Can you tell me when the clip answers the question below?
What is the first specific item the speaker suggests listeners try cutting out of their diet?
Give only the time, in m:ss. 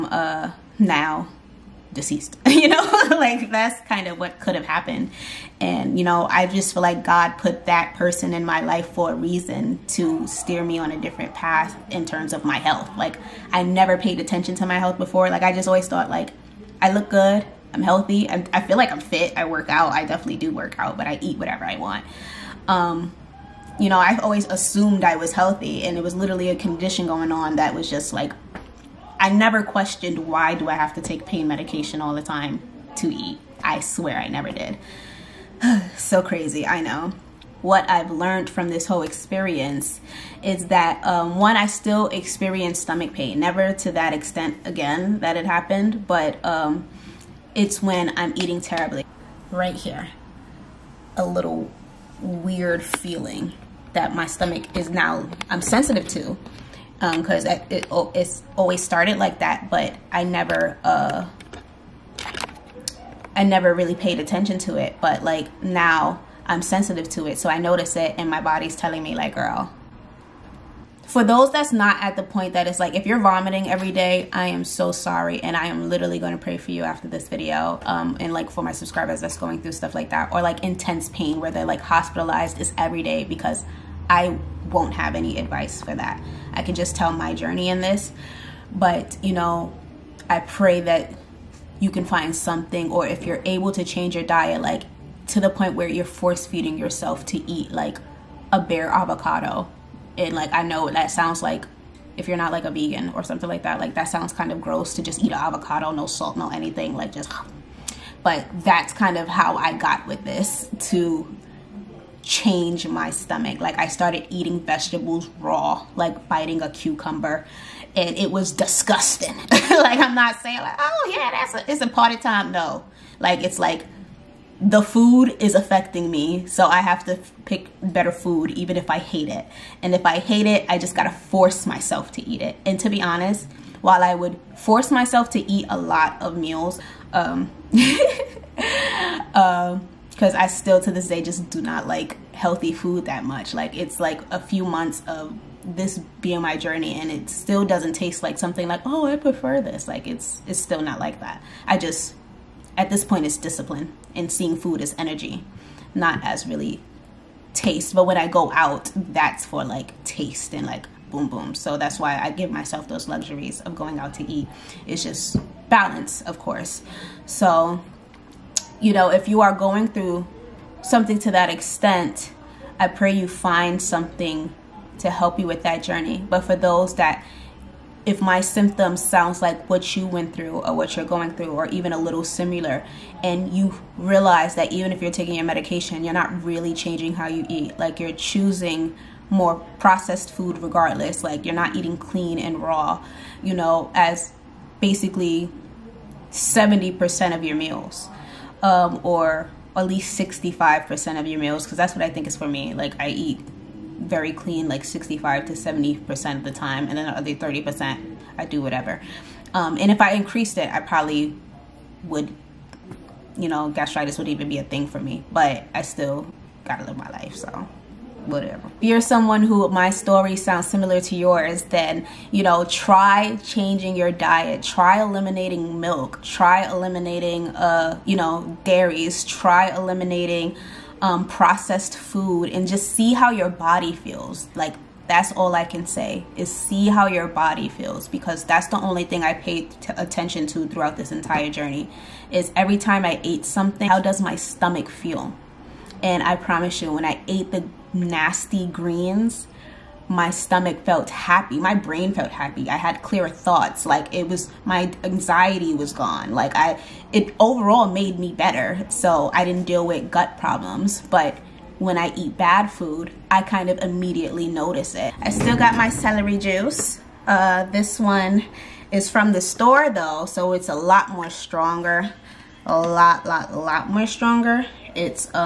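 3:45.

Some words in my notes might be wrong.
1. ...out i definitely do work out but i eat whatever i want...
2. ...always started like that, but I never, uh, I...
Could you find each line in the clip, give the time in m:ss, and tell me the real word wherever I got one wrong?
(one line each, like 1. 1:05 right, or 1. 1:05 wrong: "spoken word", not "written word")
1. 0:19 right
2. 0:58 right.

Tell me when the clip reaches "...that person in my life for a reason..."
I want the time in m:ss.
0:07.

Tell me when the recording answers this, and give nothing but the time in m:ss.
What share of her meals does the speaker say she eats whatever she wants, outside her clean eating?
3:27.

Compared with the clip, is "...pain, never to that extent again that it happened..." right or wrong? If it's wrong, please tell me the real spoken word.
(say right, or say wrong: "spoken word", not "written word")
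right.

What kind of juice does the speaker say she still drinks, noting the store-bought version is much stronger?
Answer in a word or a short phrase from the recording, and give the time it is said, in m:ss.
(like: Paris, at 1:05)
celery juice, at 4:25.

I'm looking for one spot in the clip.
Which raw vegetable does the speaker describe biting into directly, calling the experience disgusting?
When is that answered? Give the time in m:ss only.
1:56.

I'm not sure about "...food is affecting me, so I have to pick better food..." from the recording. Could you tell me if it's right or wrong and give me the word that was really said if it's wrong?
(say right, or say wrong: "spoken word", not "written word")
right.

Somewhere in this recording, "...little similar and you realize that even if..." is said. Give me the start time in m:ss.
3:01.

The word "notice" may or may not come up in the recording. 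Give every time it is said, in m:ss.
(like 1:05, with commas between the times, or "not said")
1:07, 4:24.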